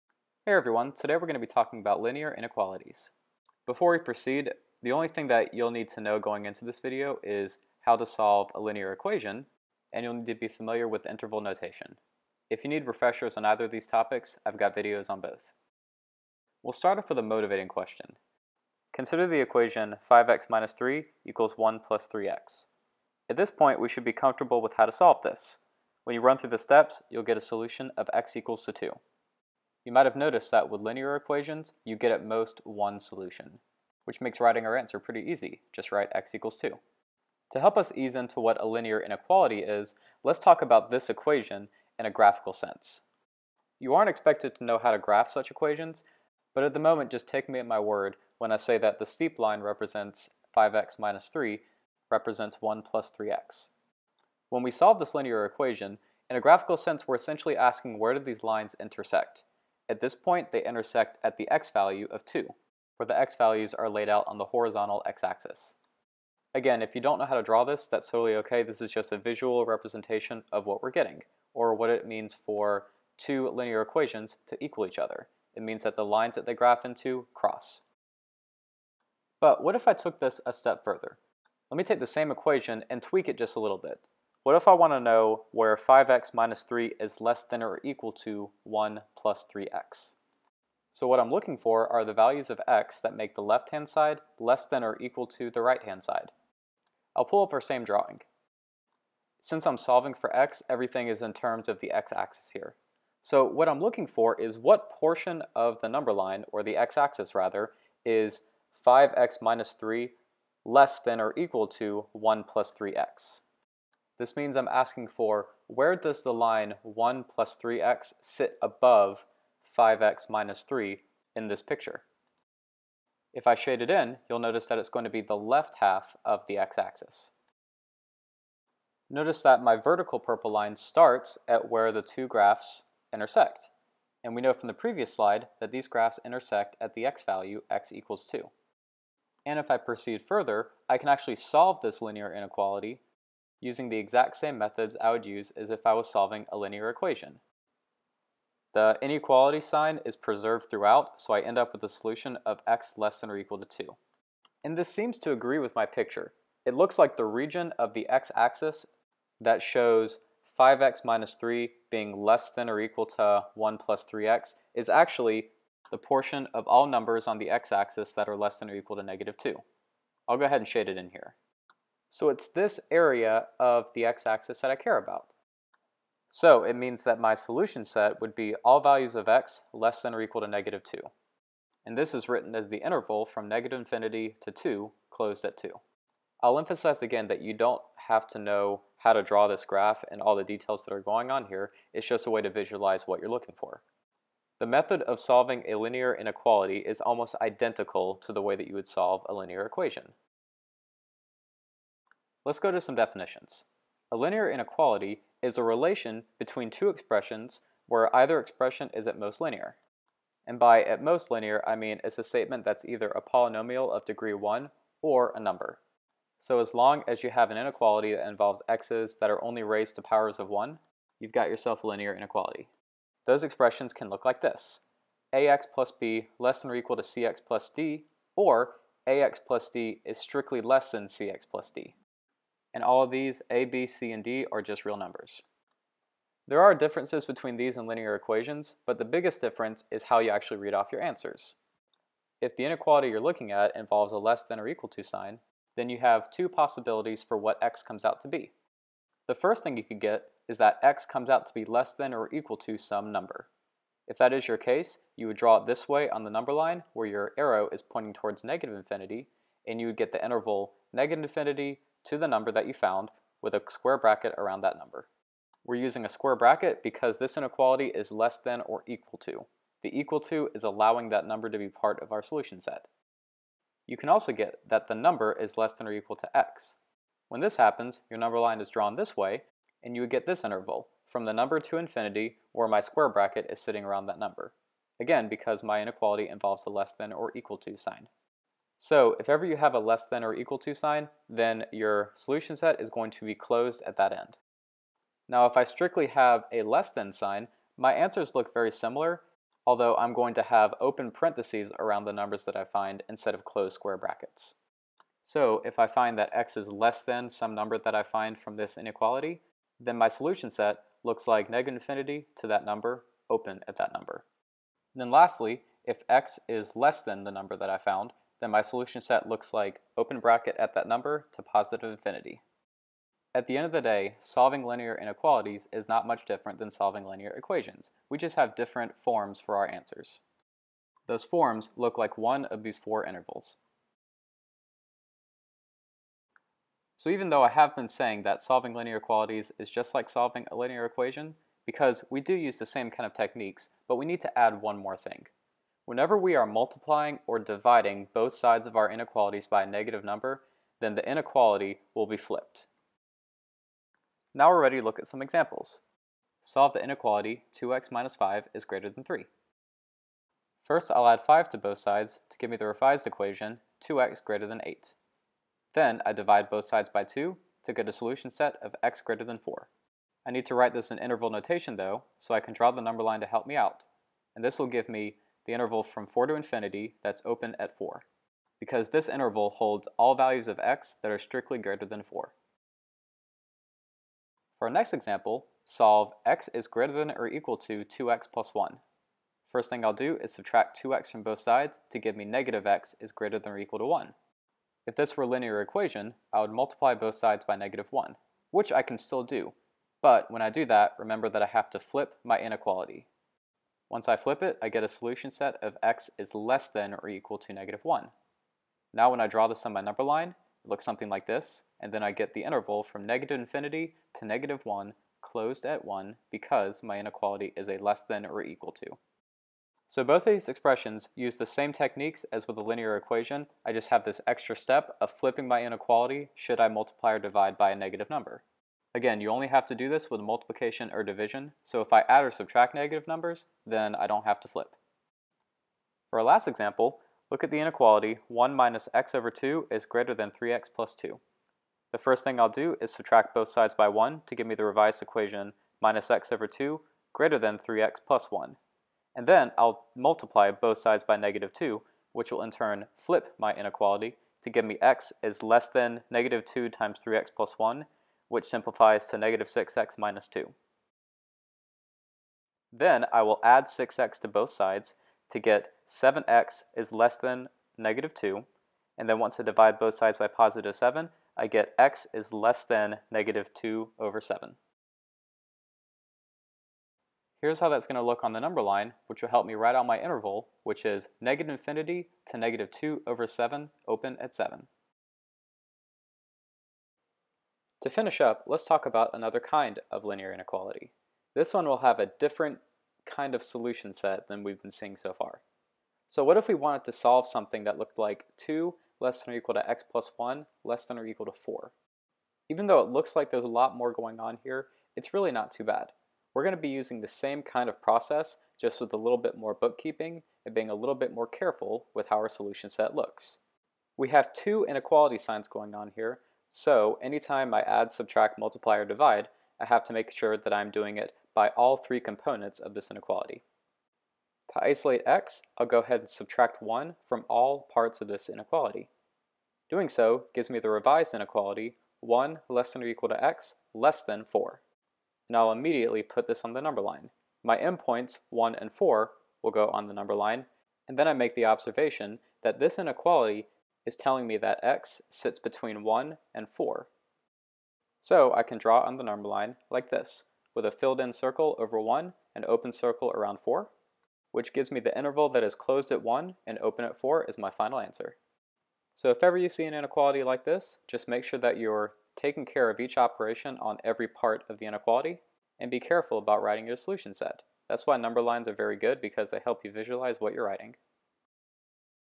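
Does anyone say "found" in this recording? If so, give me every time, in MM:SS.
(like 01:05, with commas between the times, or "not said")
04:22, 05:17.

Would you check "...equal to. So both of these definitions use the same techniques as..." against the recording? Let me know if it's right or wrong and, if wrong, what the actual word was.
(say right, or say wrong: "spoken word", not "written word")
wrong: "expressions", not "definitions".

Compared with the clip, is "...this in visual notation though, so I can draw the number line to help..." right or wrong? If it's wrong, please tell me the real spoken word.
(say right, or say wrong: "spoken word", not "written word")
wrong: "interval", not "visual".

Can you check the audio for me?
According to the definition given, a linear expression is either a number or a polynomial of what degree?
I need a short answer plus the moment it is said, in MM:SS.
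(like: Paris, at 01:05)
1, at 03:34.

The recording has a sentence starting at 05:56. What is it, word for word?
Solve the inequality 2x minus 5 is greater than 3.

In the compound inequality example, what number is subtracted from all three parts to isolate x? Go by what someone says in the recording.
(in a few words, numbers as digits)
1.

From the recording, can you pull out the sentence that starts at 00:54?
When we solve this linear equation, in a graphical sense we're essentially asking where do these lines intersect.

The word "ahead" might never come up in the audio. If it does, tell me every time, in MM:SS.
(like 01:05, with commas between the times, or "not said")
02:50, 08:45.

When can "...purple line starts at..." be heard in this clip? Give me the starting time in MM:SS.
02:10.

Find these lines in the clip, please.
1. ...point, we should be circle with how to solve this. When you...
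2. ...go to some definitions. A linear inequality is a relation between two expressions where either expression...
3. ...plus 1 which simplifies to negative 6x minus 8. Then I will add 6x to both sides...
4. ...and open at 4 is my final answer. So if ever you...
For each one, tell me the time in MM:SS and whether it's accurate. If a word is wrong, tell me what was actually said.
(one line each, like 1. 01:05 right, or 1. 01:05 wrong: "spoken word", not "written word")
1. 00:23 wrong: "comfortable", not "circle"
2. 03:22 right
3. 07:37 wrong: "2", not "8"
4. 09:16 right.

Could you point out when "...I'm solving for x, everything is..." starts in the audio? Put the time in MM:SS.
01:39.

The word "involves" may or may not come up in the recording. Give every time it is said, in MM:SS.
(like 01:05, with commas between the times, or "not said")
03:38, 04:03, 04:46.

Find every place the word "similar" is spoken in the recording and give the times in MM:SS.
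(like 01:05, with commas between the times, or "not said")
04:58.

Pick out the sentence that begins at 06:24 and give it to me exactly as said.
For our next example, solve x is greater than or equal to 2x plus 1.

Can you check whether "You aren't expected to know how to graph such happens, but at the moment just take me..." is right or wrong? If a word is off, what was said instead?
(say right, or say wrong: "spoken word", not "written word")
wrong: "equations", not "happens".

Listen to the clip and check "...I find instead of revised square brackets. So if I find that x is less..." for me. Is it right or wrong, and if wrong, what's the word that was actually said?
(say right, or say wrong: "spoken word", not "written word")
wrong: "closed", not "revised".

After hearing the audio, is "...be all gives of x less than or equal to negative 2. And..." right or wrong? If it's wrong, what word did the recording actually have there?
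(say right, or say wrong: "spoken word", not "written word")
wrong: "values", not "gives".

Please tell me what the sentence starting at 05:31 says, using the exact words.
Those forms look like one of these four intervals.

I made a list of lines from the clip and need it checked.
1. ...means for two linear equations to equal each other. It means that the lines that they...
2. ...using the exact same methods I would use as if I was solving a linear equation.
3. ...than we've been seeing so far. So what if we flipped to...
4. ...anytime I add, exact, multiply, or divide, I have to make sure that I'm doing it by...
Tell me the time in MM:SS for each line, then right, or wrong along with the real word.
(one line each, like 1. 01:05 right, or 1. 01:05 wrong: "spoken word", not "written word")
1. 01:12 right
2. 02:23 right
3. 08:14 wrong: "wanted", not "flipped"
4. 08:37 wrong: "subtract", not "exact".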